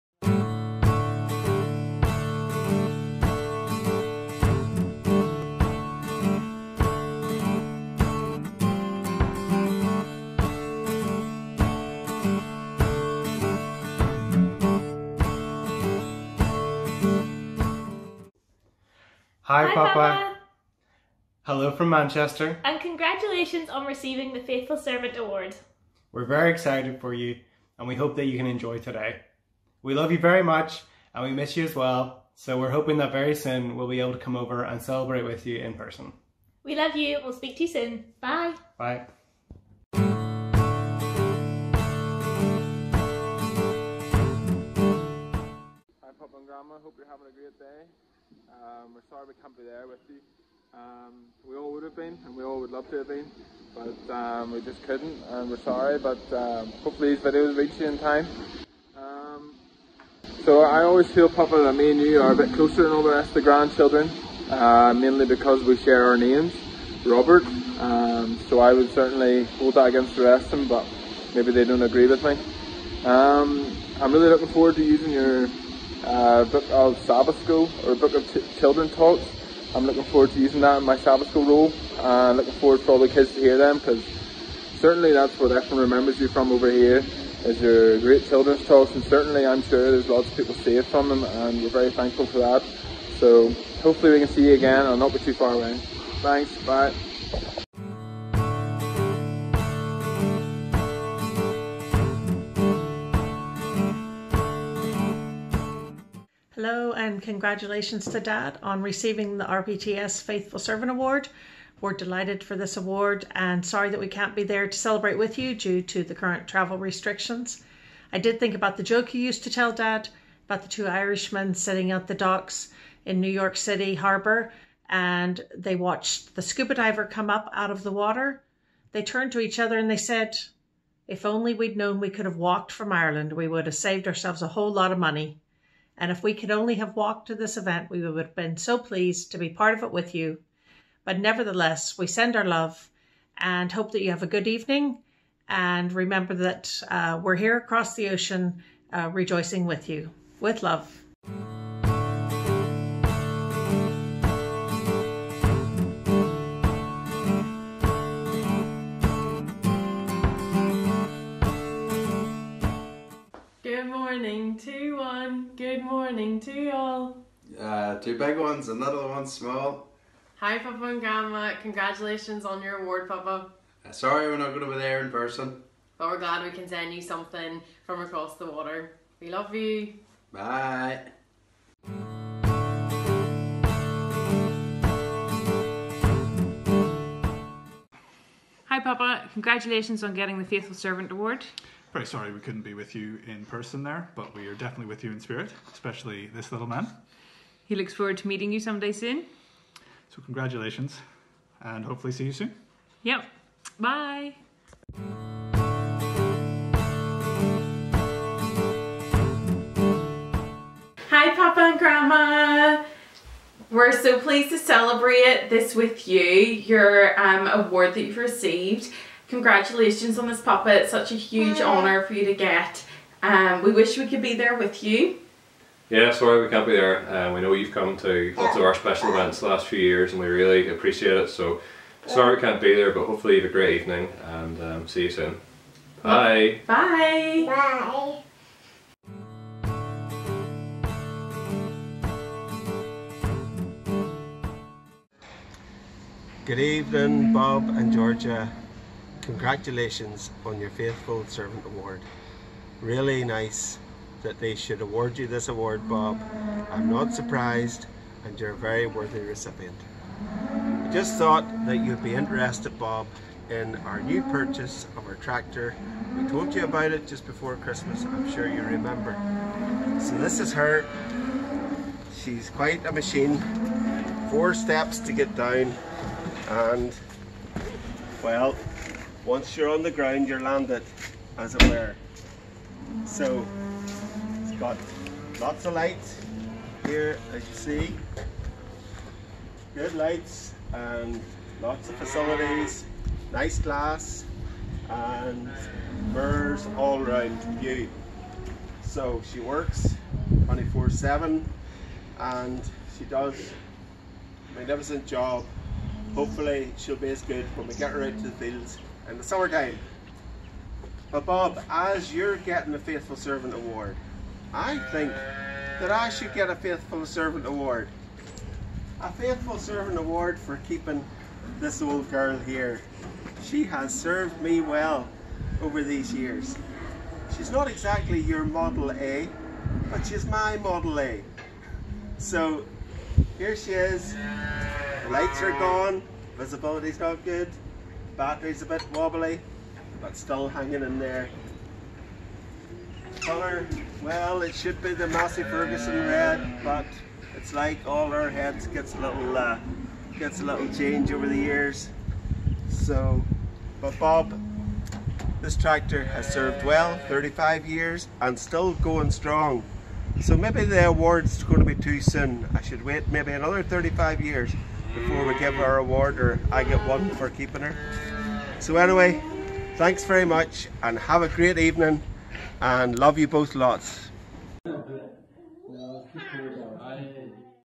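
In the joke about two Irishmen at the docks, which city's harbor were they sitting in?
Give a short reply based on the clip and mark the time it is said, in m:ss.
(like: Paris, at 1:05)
New York City, at 2:03.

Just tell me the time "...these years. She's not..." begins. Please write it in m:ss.
5:25.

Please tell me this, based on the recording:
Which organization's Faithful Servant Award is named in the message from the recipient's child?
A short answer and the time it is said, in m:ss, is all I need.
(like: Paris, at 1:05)
RPTS, at 1:49.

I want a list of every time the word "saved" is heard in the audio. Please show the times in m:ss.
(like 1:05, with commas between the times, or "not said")
1:30, 2:13.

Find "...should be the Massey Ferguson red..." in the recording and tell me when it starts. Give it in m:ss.
5:44.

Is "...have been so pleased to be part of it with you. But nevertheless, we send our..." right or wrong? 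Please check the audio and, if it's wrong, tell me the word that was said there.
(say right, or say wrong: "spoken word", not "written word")
right.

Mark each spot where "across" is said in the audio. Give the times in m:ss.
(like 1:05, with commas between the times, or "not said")
2:27, 2:58.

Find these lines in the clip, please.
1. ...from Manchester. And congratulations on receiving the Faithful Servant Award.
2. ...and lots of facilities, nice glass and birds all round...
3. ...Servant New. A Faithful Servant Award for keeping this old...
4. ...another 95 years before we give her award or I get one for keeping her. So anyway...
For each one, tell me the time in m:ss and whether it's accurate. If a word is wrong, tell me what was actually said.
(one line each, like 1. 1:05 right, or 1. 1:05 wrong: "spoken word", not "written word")
1. 0:21 right
2. 4:50 right
3. 5:17 wrong: "Award", not "New"
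4. 6:03 wrong: "35", not "95".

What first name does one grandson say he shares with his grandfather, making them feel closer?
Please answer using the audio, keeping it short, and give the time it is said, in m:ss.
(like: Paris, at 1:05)
Robert, at 1:07.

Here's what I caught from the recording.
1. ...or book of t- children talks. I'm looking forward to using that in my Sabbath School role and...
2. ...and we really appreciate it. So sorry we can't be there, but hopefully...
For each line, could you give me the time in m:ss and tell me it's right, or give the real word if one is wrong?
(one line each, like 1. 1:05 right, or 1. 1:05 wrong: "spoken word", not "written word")
1. 1:17 right
2. 3:50 right.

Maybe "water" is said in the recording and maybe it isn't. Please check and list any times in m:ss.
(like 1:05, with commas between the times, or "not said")
2:07, 2:58.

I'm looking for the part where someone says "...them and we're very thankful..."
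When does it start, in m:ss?
1:31.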